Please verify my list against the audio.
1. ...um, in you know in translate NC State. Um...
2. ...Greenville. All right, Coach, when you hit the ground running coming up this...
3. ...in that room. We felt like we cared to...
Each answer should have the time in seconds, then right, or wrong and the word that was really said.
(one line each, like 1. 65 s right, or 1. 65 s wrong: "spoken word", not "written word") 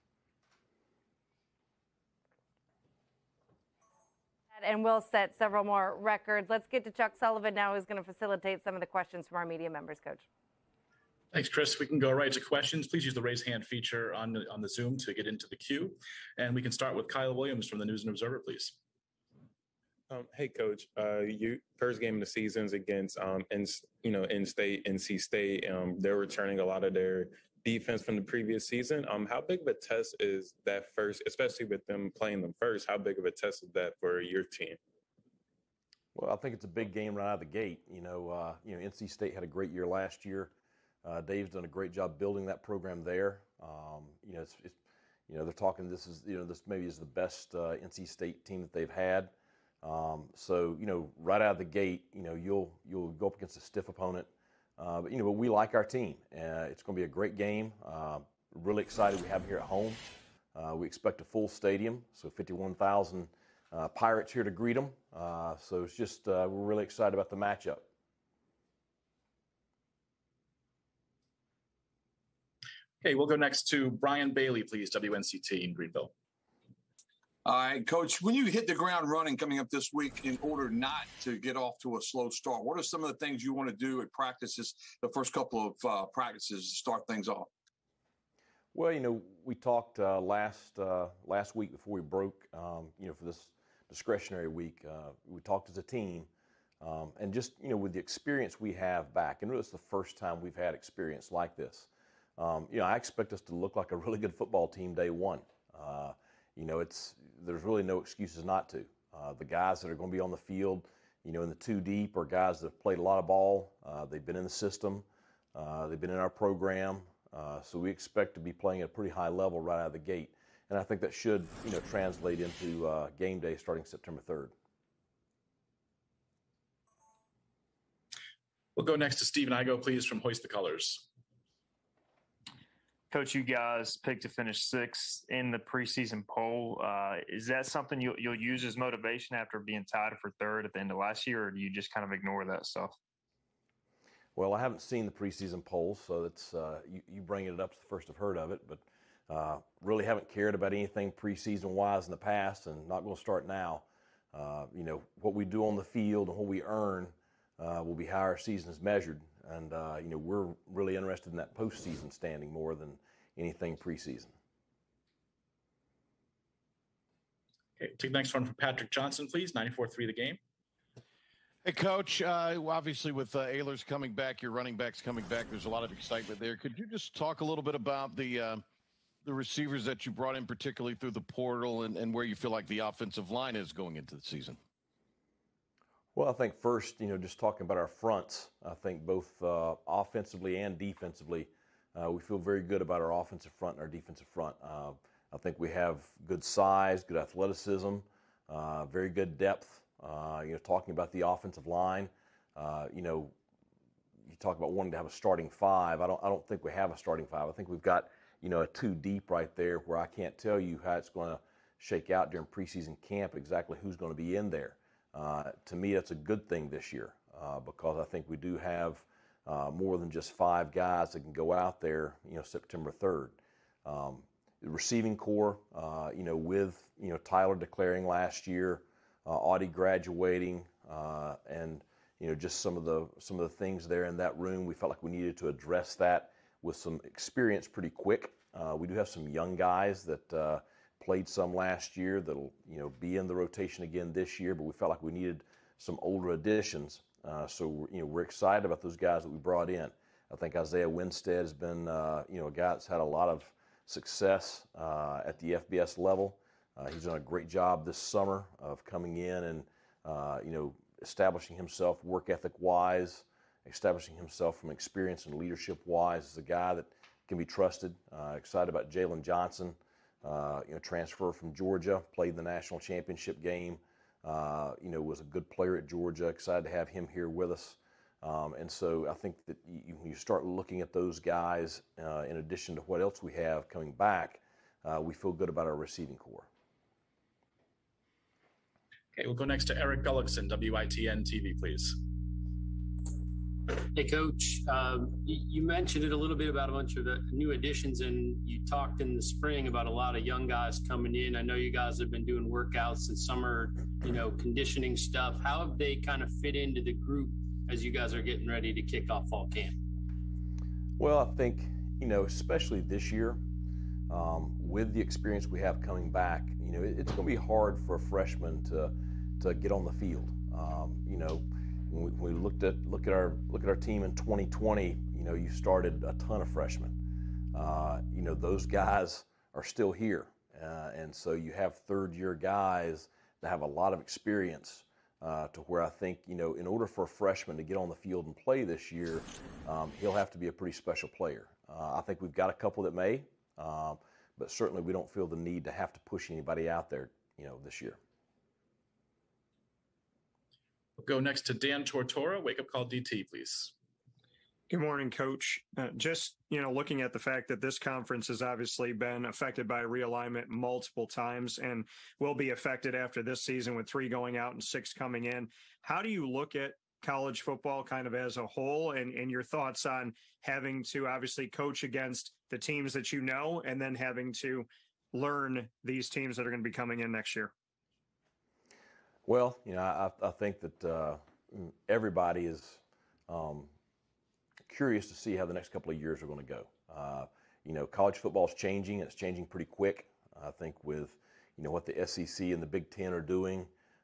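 1. 23 s wrong: "state", not "translate"
2. 75 s right
3. 234 s wrong: "needed", not "cared".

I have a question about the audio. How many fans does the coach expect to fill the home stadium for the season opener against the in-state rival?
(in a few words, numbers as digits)
51,000.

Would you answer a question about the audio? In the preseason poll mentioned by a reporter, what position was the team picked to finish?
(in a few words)
sixth.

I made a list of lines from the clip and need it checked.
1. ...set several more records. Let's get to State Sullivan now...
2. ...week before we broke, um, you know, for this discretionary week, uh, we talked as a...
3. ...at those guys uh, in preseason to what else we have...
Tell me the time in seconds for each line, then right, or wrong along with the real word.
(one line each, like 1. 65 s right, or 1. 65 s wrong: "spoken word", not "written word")
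1. 5 s wrong: "Chuck", not "State"
2. 91 s right
3. 280 s wrong: "addition", not "preseason".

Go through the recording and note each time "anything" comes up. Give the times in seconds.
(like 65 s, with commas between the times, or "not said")
150 s, 163 s.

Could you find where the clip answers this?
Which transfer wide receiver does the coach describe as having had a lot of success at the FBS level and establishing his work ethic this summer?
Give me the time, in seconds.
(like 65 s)
250 s.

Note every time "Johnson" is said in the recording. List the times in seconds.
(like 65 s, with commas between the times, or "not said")
168 s, 269 s.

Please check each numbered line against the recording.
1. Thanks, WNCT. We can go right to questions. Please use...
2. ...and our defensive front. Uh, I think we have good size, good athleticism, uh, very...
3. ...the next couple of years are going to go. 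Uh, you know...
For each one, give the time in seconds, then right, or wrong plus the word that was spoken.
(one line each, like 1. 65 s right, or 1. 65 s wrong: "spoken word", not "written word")
1. 11 s wrong: "Chris", not "WNCT"
2. 193 s right
3. 385 s right.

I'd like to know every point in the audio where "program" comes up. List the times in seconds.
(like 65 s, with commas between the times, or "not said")
42 s, 116 s.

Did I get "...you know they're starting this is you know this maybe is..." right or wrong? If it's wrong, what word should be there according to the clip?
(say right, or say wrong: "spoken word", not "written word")
wrong: "talking", not "starting".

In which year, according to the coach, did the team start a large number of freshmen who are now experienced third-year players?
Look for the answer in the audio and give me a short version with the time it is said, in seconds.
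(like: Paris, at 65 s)
2020, at 324 s.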